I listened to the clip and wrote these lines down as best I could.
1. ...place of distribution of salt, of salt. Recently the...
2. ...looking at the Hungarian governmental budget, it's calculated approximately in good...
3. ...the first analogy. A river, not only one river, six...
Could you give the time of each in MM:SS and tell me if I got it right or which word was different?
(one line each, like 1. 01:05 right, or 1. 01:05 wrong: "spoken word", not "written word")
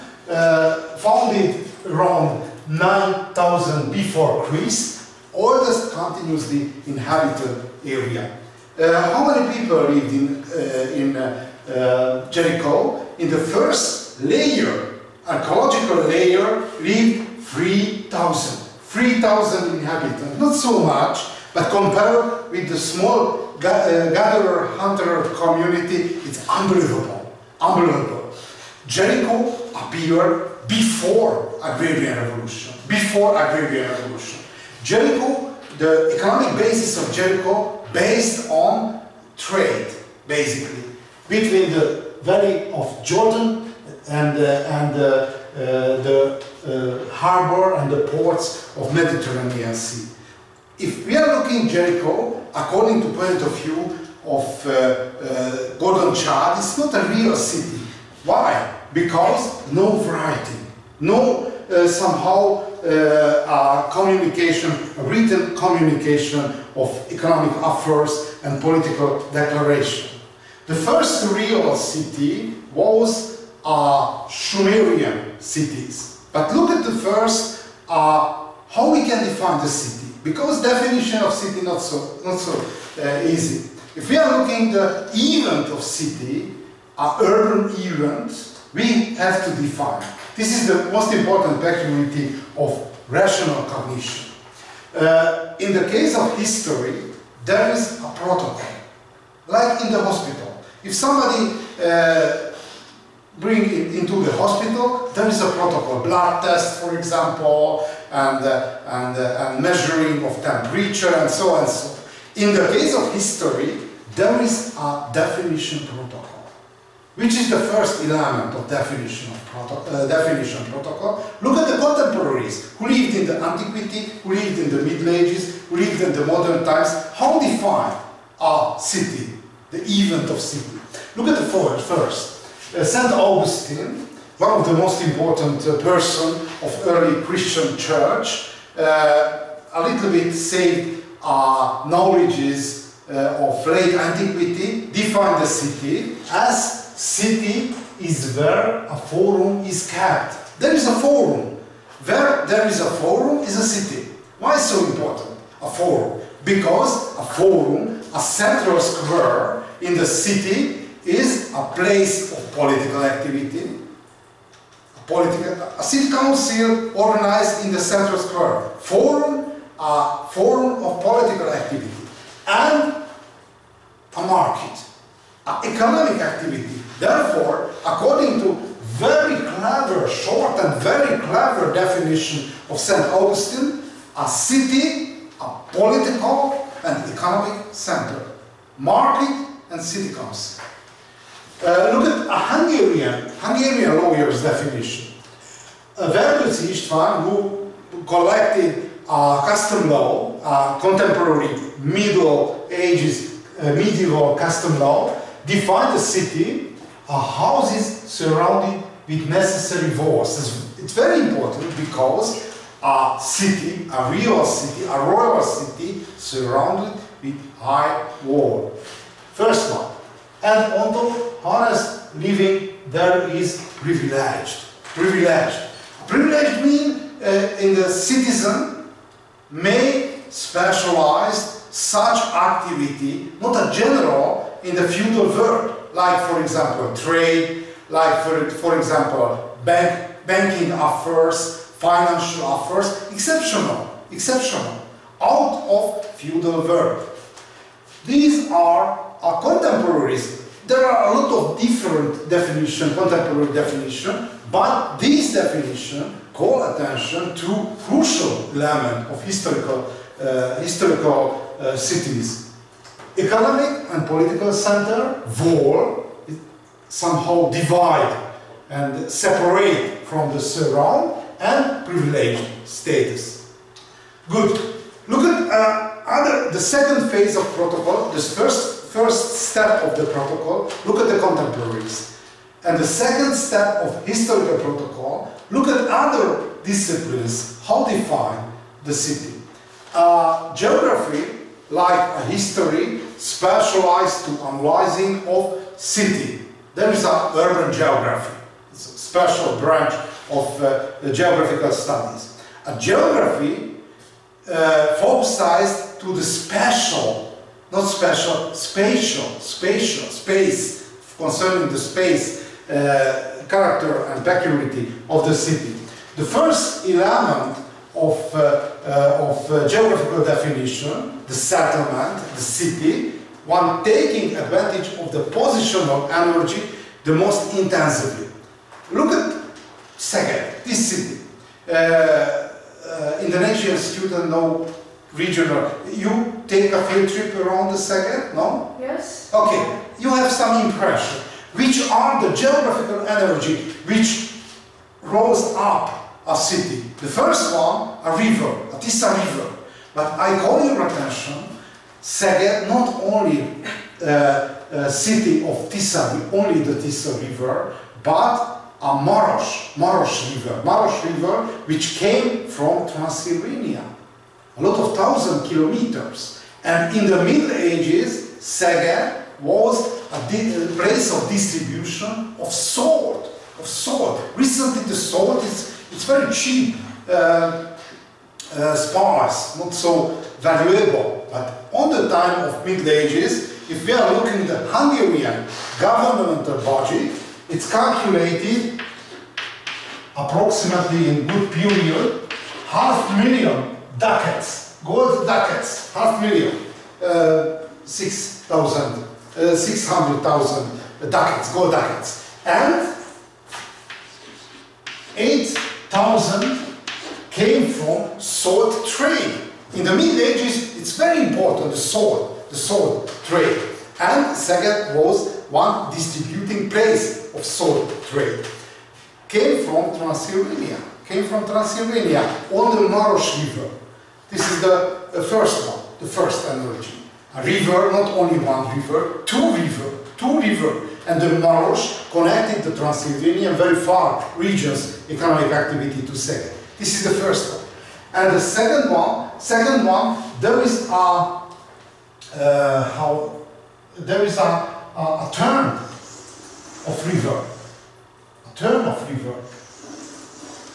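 1. 06:10 right
2. 06:24 right
3. 07:05 wrong: "two", not "six".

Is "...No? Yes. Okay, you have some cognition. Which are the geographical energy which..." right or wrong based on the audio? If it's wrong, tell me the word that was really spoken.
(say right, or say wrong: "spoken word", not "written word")
wrong: "impression", not "cognition".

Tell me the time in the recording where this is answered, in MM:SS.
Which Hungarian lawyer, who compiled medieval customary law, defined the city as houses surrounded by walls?
03:16.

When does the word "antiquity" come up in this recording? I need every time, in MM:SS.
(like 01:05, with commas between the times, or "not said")
02:03, 02:23.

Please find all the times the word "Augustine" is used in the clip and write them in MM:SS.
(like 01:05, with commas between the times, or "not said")
02:13, 03:03.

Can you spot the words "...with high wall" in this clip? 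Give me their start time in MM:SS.
03:37.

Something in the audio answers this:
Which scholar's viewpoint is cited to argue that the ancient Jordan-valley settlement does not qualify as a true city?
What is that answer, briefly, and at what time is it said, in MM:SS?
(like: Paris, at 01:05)
Gordon Childe, at 00:55.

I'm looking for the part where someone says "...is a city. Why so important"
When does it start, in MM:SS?
02:33.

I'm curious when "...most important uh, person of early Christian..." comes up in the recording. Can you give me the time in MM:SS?
02:14.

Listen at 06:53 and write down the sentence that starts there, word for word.
And Szeged was one distributing place of salt trade.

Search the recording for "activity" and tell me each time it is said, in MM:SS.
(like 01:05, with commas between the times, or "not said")
02:43, 02:51, 02:56, 03:52, 07:15.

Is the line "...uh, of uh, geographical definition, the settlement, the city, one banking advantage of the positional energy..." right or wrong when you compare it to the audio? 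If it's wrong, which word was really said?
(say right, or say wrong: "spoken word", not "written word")
wrong: "taking", not "banking".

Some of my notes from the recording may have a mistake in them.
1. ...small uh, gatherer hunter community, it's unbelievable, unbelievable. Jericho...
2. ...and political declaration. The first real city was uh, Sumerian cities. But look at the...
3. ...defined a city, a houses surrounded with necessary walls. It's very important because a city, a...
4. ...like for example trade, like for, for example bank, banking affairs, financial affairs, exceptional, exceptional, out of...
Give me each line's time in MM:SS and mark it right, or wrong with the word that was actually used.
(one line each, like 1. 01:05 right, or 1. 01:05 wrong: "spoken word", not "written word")
1. 00:22 right
2. 01:08 right
3. 03:25 right
4. 03:55 right.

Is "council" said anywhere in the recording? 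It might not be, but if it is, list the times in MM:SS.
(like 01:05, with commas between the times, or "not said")
02:46, 03:10.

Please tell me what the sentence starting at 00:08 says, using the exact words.
Uh, how many people lived in, uh, in Jericho?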